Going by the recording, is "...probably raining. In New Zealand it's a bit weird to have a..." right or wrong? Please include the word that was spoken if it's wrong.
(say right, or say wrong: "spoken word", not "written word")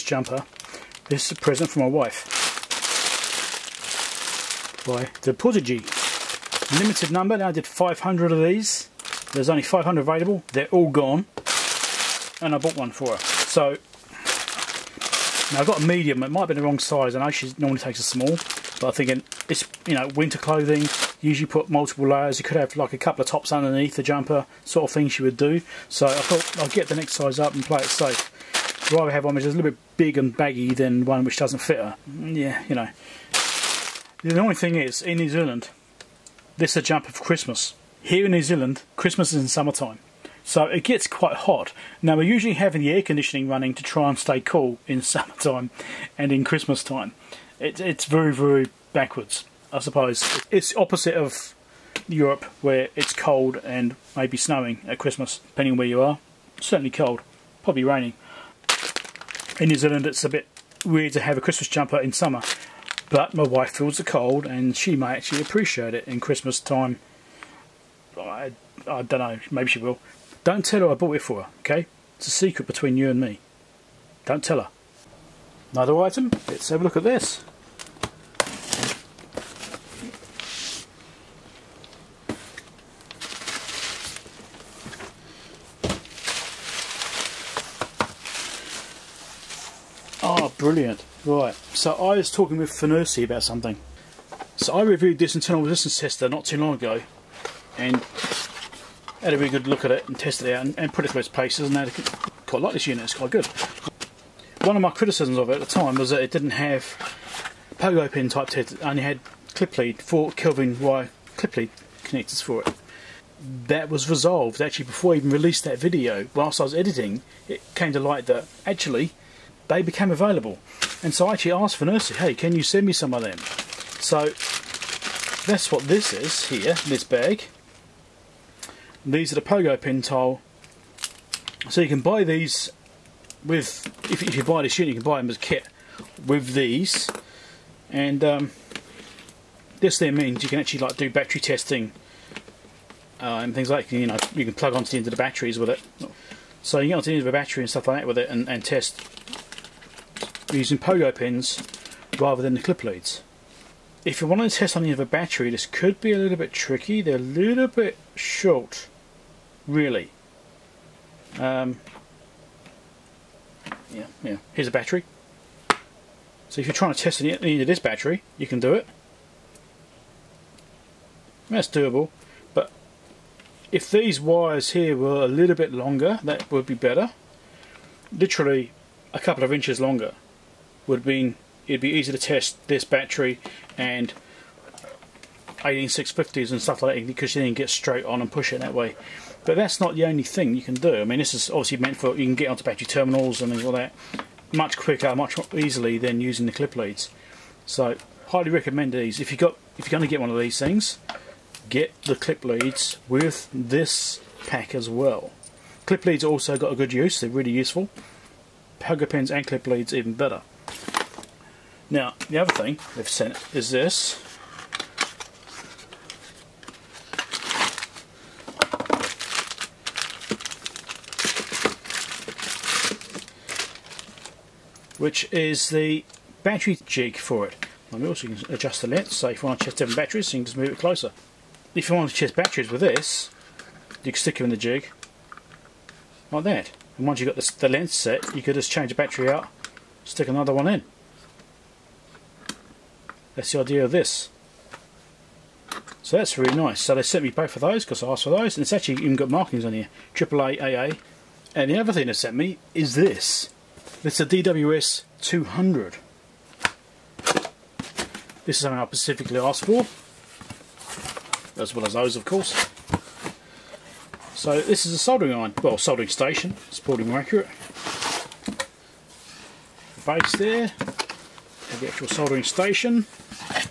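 right.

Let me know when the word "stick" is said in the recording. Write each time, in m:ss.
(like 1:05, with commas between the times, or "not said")
3:54, 4:00.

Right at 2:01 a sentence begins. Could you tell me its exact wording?
And so I actually asked FNIRSI, hey, can you send me some of them?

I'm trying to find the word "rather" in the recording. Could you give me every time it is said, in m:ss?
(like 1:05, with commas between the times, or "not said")
0:28, 2:32.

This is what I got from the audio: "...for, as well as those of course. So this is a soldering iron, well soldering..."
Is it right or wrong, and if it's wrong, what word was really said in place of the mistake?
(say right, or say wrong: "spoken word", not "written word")
right.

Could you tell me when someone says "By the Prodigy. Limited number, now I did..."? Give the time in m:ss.
0:04.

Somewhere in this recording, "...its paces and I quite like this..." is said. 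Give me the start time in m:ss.
1:41.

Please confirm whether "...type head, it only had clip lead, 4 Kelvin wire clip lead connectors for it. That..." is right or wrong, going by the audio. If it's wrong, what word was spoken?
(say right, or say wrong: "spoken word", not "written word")
right.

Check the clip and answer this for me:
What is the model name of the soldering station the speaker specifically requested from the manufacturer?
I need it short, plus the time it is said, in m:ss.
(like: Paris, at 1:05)
DWS 200, at 4:14.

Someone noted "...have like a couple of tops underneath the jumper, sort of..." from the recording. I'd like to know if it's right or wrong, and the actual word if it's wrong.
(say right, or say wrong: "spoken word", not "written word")
right.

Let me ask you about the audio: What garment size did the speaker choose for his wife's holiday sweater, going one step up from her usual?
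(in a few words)
Medium.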